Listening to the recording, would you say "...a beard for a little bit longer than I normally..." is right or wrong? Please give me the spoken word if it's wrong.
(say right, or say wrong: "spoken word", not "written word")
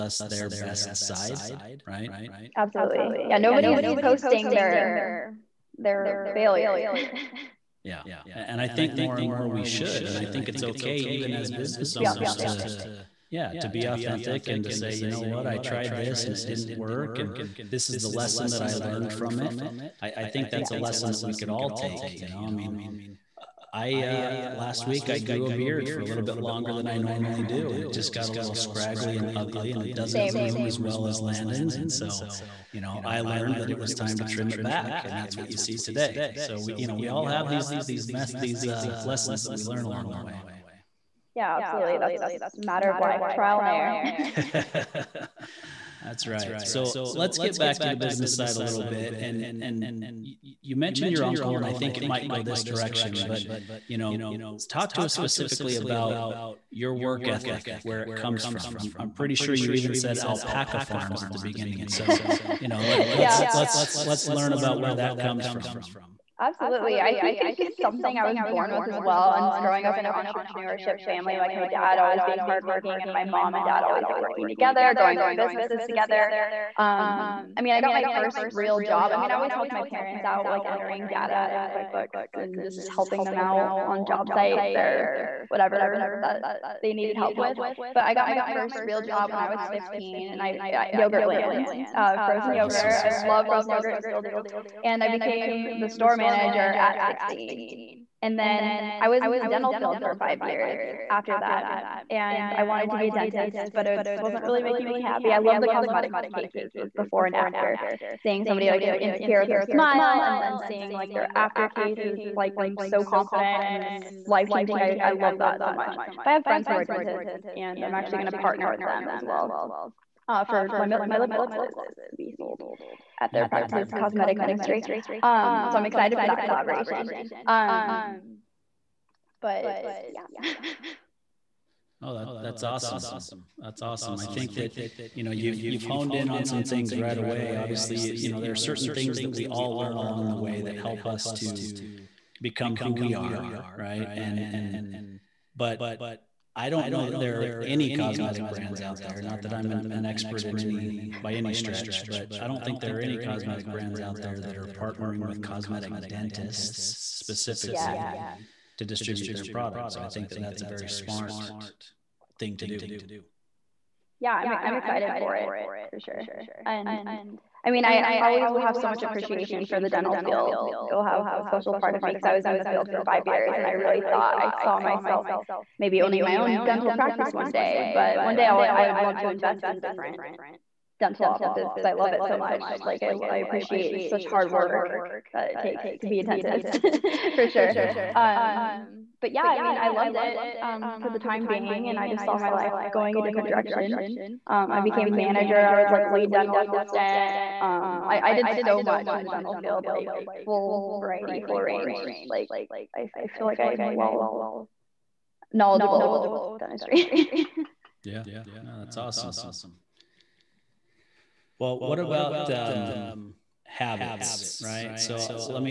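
right.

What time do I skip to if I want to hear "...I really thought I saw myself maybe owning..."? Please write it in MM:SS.
02:53.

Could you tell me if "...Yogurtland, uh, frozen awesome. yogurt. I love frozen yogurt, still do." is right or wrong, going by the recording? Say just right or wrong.
right.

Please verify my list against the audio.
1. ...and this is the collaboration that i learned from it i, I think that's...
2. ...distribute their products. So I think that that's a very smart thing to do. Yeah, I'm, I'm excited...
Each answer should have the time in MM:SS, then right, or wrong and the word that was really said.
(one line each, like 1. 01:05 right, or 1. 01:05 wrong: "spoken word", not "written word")
1. 00:17 wrong: "lesson", not "collaboration"
2. 02:38 right.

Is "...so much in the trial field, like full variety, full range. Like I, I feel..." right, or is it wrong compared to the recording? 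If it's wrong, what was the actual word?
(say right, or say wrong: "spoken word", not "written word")
wrong: "dental", not "trial".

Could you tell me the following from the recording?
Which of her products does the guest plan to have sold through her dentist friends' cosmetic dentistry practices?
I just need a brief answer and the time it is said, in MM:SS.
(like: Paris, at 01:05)
lip glosses, at 02:01.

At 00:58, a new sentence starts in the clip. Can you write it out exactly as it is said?
I'm, I'm pretty sure you even said alpaca farms at the beginning.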